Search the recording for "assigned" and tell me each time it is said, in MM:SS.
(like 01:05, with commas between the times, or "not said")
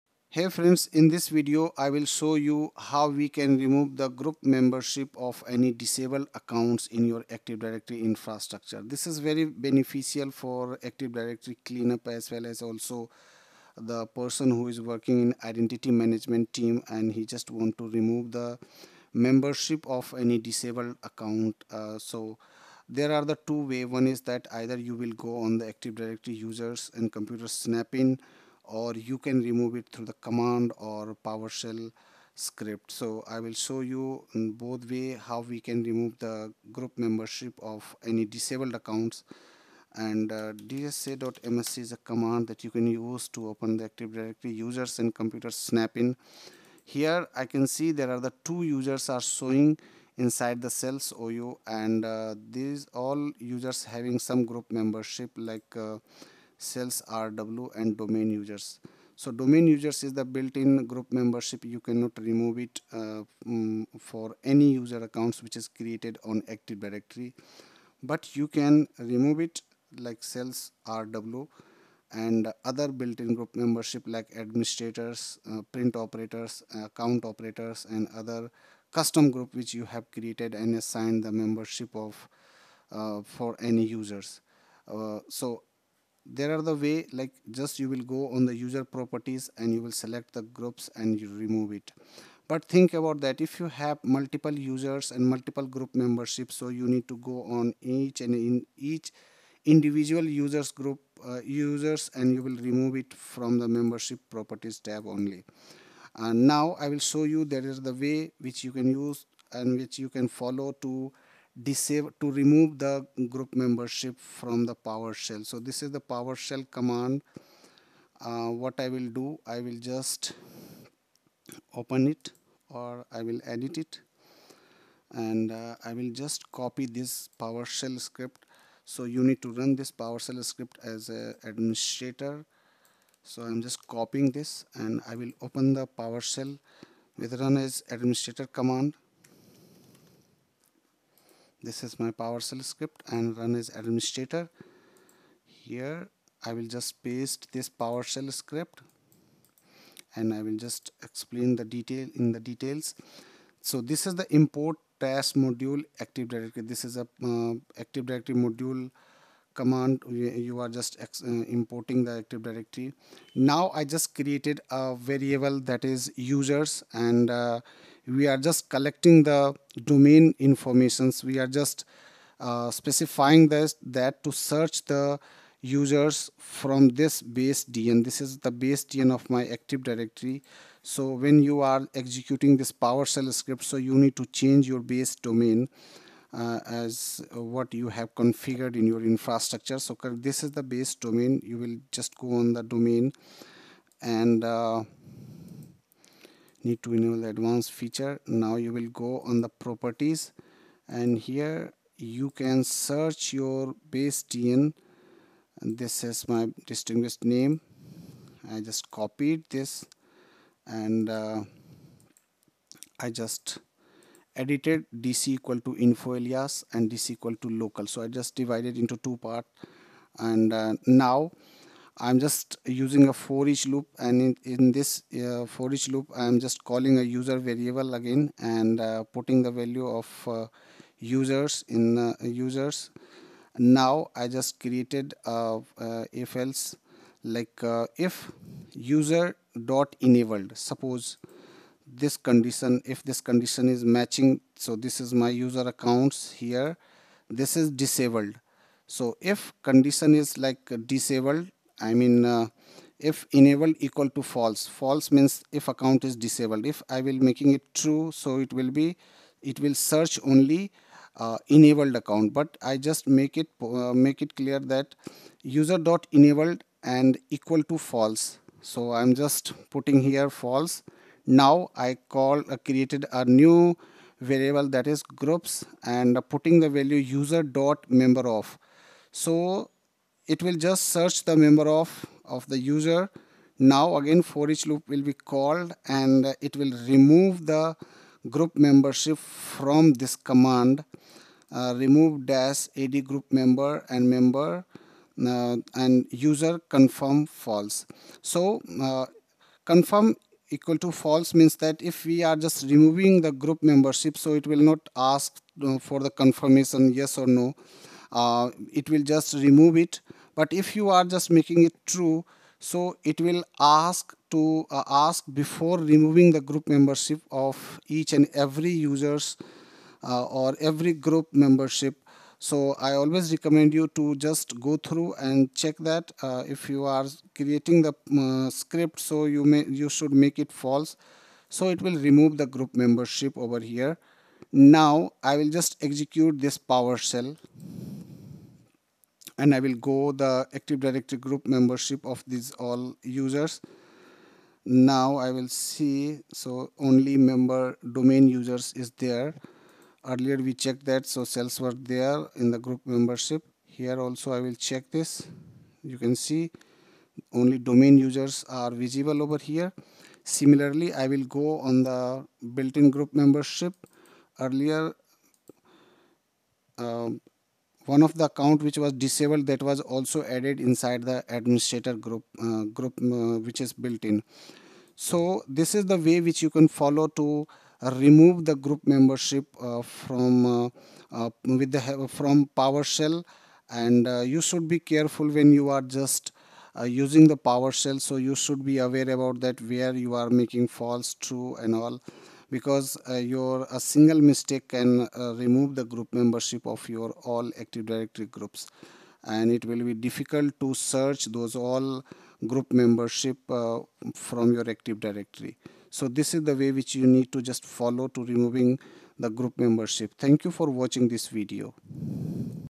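01:20.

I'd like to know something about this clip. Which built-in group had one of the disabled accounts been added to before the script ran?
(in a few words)
administrator group.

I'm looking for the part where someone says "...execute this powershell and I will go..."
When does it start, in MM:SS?
05:35.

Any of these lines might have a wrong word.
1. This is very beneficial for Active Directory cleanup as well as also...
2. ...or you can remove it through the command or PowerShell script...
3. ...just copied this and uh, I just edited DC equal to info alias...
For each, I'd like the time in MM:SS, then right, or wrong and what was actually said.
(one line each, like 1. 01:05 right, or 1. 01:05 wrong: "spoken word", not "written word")
1. 00:08 right
2. 00:28 right
3. 03:28 right.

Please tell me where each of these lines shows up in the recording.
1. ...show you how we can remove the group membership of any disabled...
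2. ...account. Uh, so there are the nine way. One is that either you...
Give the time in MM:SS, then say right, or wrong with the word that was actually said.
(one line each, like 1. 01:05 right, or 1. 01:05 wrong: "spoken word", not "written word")
1. 00:02 right
2. 00:21 wrong: "two", not "nine".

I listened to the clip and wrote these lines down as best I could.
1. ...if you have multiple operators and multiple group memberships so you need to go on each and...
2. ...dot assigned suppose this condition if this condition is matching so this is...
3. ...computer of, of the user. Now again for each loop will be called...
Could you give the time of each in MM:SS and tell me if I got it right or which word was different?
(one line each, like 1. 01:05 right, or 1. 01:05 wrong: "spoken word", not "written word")
1. 01:33 wrong: "users", not "operators"
2. 03:59 wrong: "enabled", not "assigned"
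3. 04:41 wrong: "member", not "computer".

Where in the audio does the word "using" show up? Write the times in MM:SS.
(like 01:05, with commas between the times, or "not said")
03:42, 06:26.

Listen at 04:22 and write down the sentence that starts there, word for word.
But I just make it uh, make it clear that user dot enabled and equal to false.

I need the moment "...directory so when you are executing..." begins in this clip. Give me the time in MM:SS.
02:59.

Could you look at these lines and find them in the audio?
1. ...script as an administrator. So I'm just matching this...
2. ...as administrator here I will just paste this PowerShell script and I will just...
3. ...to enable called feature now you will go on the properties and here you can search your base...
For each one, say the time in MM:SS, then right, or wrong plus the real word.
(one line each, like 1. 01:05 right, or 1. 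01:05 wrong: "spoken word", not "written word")
1. 02:10 wrong: "copying", not "matching"
2. 02:23 right
3. 03:16 wrong: "advanced", not "called".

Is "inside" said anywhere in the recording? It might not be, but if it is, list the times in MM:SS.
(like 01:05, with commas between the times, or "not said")
00:50, 06:10.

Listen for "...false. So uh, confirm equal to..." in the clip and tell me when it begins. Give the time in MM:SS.
04:57.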